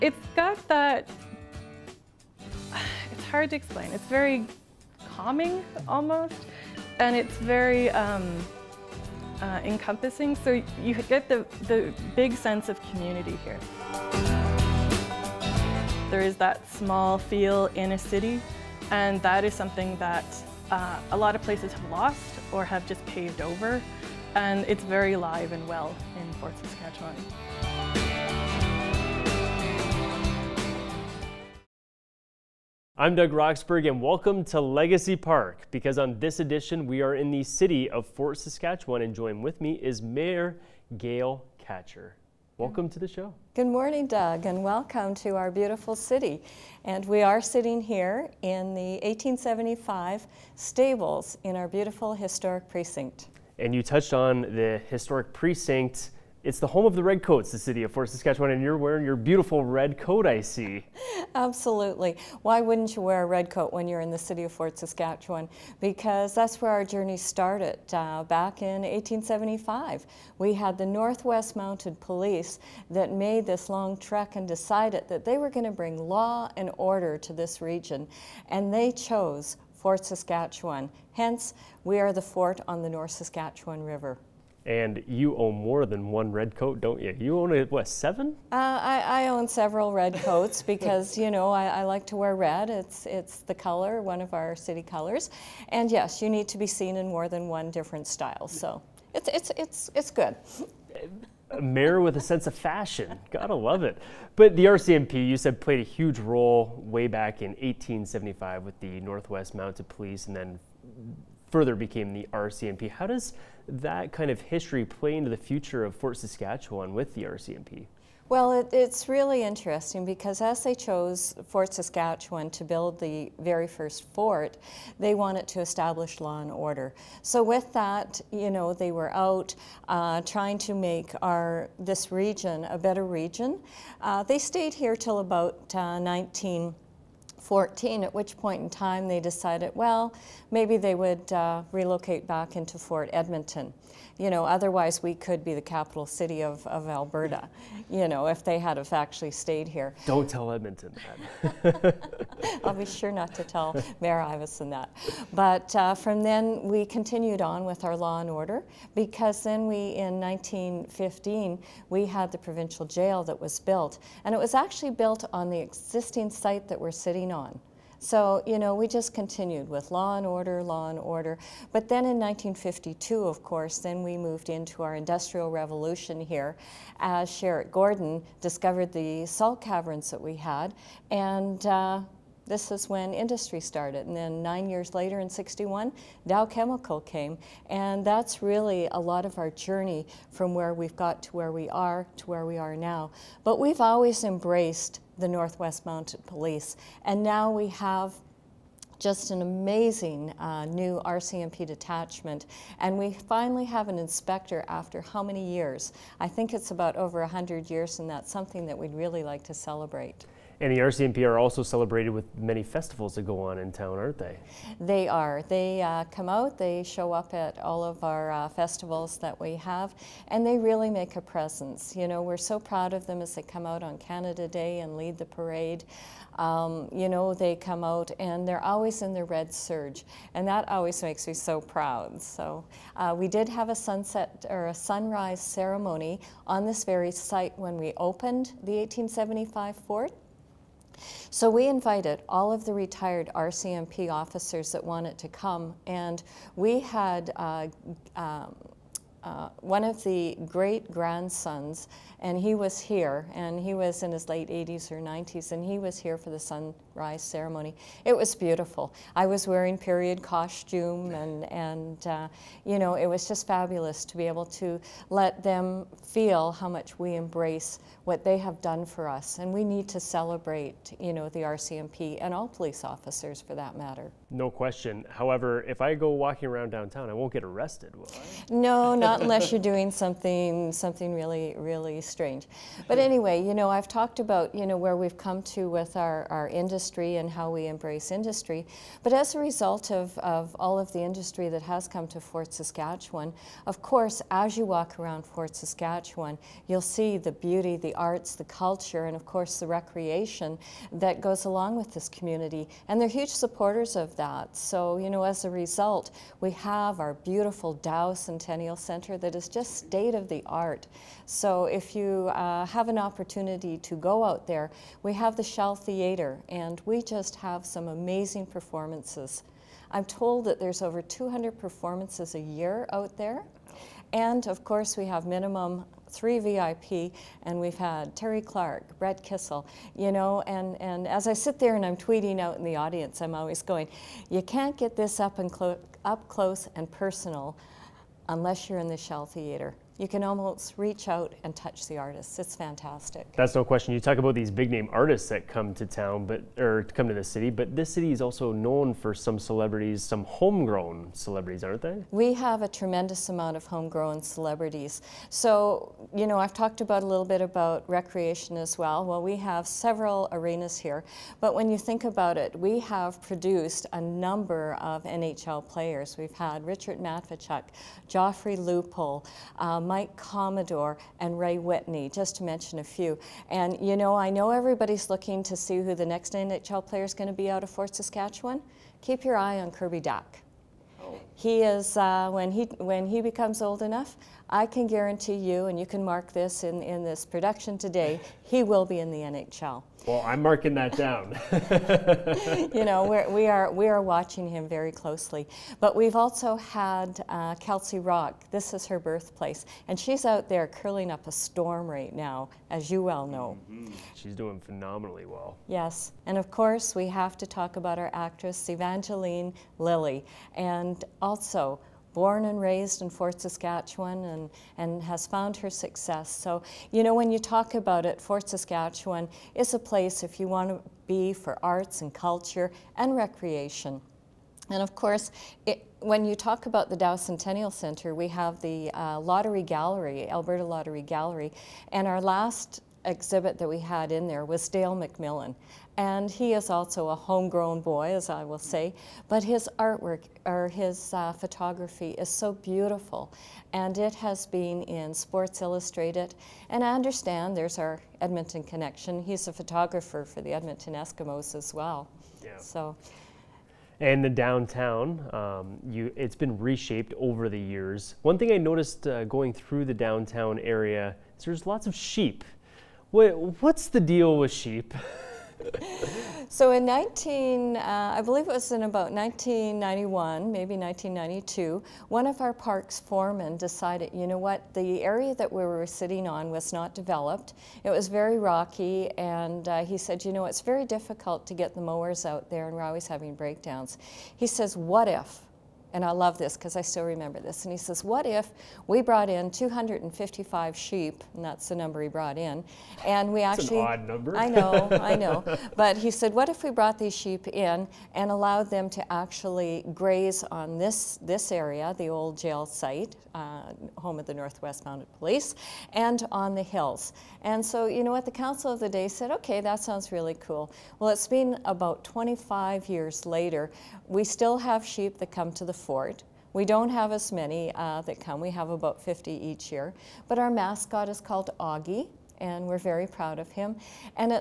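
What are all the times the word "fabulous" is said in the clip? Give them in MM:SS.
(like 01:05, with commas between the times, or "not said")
04:23.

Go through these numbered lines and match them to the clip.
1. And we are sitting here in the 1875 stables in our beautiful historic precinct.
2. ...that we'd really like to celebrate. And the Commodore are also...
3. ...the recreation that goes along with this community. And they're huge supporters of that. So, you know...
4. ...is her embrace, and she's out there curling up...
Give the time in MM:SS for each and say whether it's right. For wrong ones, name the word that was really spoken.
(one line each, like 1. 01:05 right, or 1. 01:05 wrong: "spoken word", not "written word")
1. 00:46 right
2. 03:28 wrong: "RCMP", not "Commodore"
3. 04:59 right
4. 06:38 wrong: "birthplace", not "embrace".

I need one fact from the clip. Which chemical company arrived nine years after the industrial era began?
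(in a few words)
Dow Chemical.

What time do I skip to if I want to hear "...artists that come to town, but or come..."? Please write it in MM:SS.
05:44.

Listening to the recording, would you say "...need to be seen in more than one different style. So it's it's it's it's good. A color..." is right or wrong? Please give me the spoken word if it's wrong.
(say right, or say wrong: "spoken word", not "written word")
wrong: "mayor", not "color".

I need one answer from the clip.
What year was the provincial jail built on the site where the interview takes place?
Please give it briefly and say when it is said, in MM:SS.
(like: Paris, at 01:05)
1915, at 02:40.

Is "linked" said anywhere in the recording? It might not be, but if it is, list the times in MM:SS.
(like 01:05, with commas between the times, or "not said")
not said.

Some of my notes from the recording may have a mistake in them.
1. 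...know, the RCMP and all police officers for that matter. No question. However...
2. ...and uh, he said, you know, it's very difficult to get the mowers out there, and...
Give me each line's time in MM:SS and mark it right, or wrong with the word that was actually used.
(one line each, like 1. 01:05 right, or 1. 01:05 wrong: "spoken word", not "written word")
1. 04:31 right
2. 07:59 right.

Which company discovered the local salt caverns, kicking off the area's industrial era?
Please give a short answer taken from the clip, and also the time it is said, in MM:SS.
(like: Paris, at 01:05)
Sherritt Gordon, at 02:57.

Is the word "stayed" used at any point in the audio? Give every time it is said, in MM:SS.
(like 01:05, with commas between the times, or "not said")
02:14, 02:29.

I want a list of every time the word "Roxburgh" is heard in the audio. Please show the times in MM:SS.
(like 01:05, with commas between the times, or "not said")
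00:33.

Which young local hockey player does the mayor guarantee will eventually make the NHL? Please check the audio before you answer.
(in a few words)
Kirby Dach.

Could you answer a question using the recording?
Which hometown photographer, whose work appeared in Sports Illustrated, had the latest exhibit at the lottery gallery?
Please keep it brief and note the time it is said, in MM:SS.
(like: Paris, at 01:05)
Dale McMillan, at 07:14.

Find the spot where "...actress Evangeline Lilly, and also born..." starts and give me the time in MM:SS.
06:48.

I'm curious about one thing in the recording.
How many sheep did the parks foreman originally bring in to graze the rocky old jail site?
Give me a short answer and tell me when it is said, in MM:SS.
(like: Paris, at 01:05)
255, at 08:09.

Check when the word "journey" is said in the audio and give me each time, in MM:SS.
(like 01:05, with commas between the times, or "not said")
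01:06, 03:09.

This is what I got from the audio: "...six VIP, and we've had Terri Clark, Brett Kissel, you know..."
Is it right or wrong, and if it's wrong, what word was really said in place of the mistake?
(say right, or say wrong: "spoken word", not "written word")
wrong: "three", not "six".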